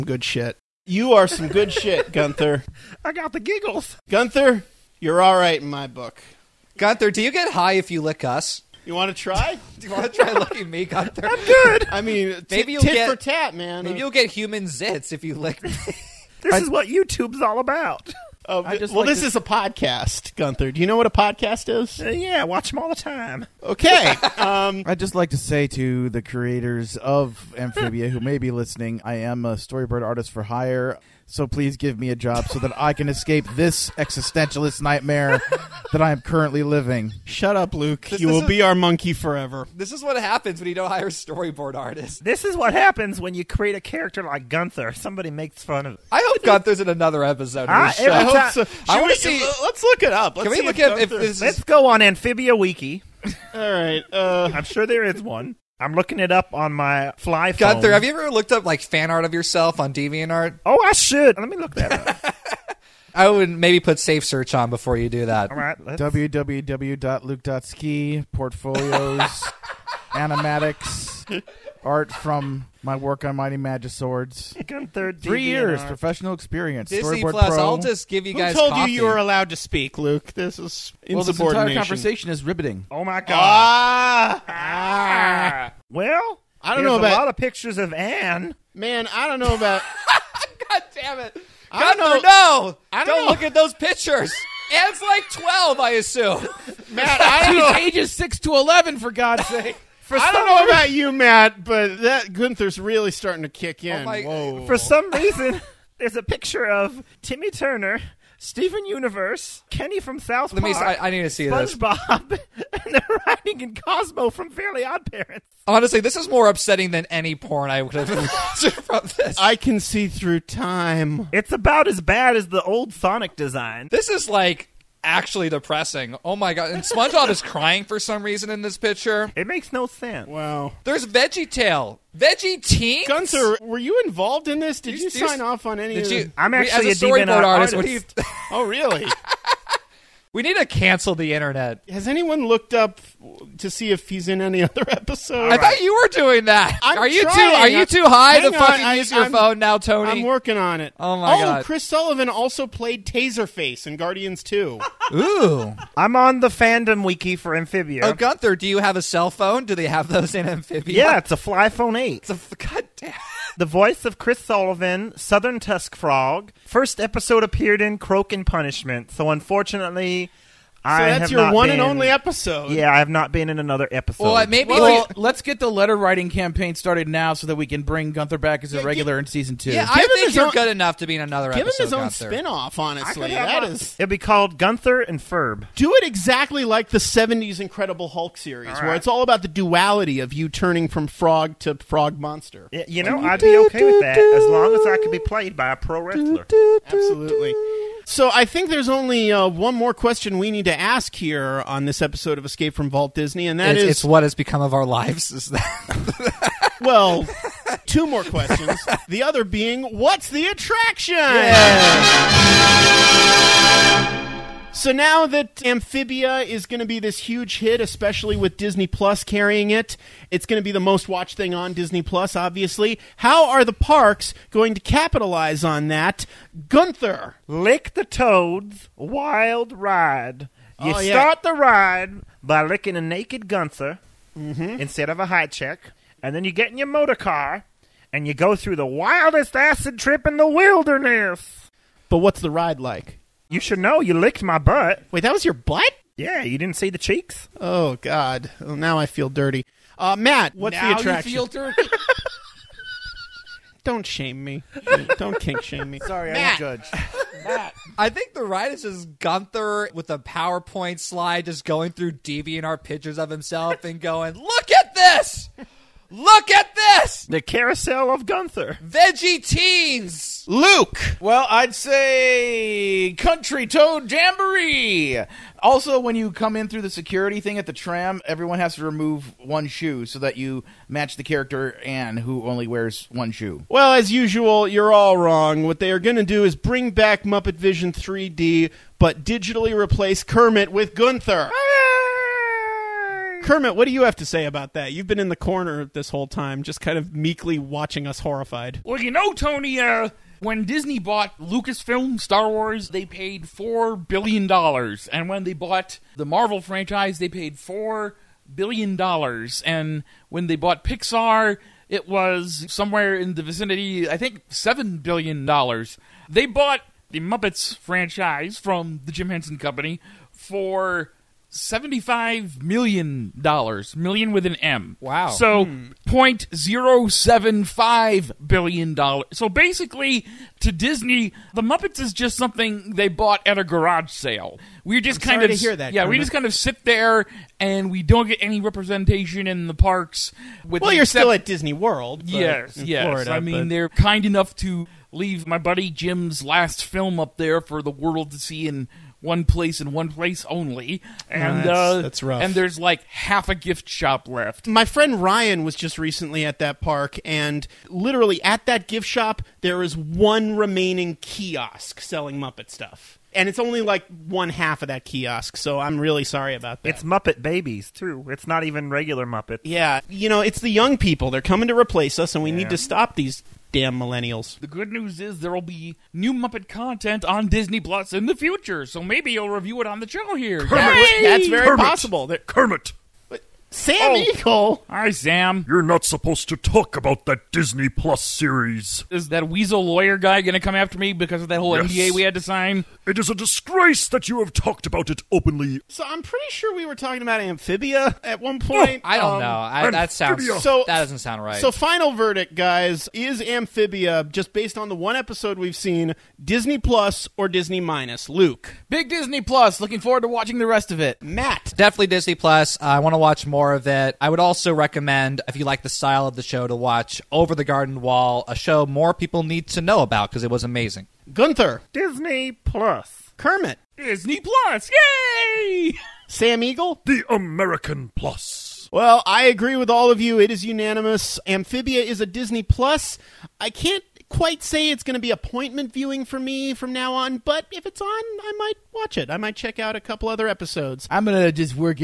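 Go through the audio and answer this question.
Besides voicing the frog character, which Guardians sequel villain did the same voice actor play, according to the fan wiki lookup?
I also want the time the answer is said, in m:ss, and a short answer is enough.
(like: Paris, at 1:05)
Taserface, at 2:33.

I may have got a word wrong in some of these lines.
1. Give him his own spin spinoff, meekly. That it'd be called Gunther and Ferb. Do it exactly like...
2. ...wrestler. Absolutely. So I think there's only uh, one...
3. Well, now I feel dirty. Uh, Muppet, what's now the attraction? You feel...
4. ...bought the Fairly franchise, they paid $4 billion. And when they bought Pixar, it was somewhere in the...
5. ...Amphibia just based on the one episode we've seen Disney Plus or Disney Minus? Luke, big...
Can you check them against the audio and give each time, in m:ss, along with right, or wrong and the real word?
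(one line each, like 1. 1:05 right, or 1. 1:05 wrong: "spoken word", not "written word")
1. 3:01 wrong: "honestly", not "meekly"
2. 3:16 right
3. 4:08 wrong: "Matt", not "Muppet"
4. 5:05 wrong: "Marvel", not "Fairly"
5. 6:43 right.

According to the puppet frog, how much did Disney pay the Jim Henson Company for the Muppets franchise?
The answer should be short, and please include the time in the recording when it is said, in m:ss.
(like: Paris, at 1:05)
$75 million, at 5:21.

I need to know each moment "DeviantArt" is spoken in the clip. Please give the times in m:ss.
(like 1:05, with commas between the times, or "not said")
0:59, 4:22.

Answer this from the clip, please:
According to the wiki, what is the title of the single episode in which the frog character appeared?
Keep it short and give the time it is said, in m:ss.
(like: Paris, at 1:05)
Croak and Punishment, at 2:47.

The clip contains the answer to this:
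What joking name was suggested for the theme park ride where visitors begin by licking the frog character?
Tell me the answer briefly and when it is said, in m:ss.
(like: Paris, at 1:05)
Lick the Toads Wild Ride, at 3:47.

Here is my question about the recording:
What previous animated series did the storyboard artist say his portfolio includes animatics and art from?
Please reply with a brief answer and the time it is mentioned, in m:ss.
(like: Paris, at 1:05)
Mighty Magiswords, at 1:13.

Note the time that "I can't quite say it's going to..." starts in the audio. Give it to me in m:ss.
7:13.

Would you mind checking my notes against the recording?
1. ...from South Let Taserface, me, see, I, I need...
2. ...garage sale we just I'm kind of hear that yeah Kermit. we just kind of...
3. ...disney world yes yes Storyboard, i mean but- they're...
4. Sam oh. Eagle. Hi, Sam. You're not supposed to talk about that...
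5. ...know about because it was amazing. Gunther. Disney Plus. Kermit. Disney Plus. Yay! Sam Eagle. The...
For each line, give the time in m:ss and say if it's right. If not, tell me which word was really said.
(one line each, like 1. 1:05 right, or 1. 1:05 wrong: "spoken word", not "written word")
1. 1:49 wrong: "Park", not "Taserface"
2. 5:33 right
3. 5:41 wrong: "Florida", not "Storyboard"
4. 6:23 right
5. 6:59 right.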